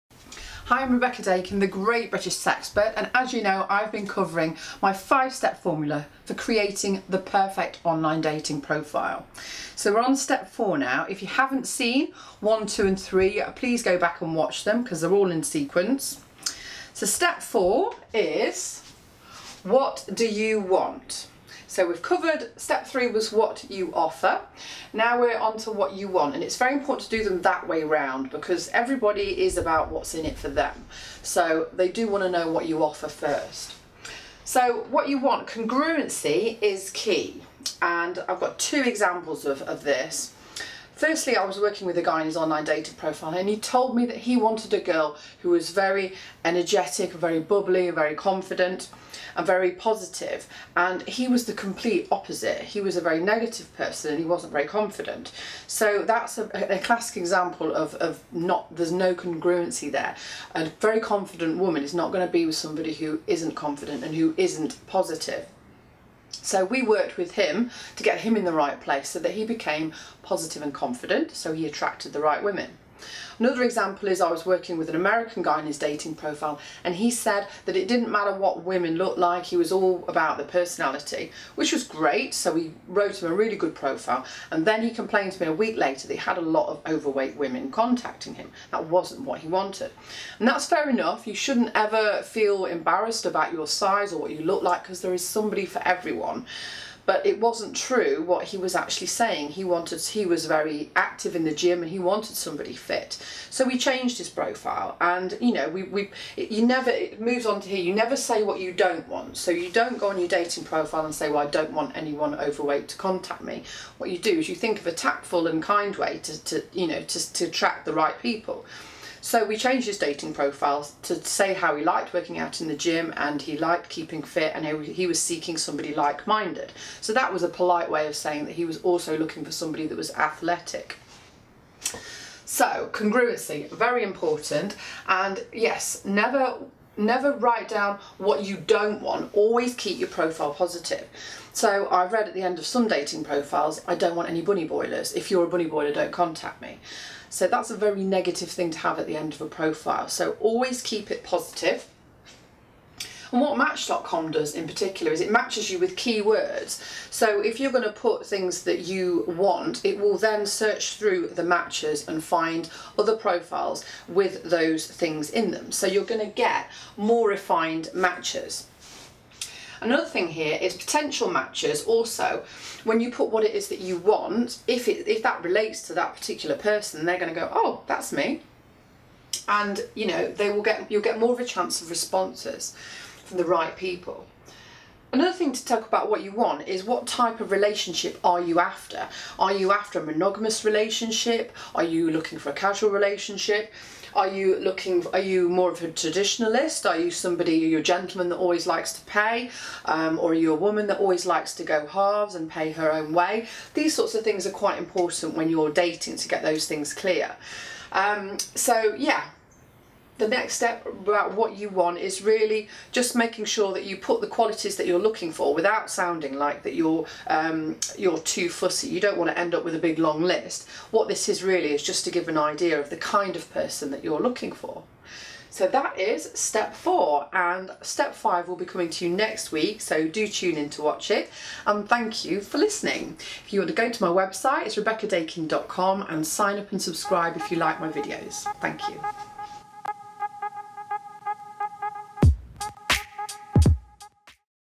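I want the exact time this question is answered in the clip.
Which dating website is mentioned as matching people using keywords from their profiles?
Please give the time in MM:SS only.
02:33.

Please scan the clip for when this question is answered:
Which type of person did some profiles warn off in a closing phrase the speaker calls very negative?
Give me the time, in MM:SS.
02:24.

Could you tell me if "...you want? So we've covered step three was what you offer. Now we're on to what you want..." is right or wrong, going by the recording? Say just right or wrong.
right.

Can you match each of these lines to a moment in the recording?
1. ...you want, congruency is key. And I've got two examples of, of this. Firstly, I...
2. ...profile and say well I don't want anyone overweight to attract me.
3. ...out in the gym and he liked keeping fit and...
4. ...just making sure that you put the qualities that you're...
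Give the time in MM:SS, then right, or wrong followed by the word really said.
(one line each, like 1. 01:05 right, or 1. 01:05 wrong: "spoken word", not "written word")
1. 00:35 right
2. 01:50 wrong: "contact", not "attract"
3. 02:02 right
4. 03:32 right.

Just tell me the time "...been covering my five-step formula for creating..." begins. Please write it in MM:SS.
00:03.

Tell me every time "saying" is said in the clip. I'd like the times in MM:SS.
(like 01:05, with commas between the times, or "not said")
01:39, 02:08.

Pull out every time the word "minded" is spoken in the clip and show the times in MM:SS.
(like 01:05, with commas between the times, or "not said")
02:05.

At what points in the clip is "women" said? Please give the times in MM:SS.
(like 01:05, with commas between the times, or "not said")
01:12, 01:18, 01:27.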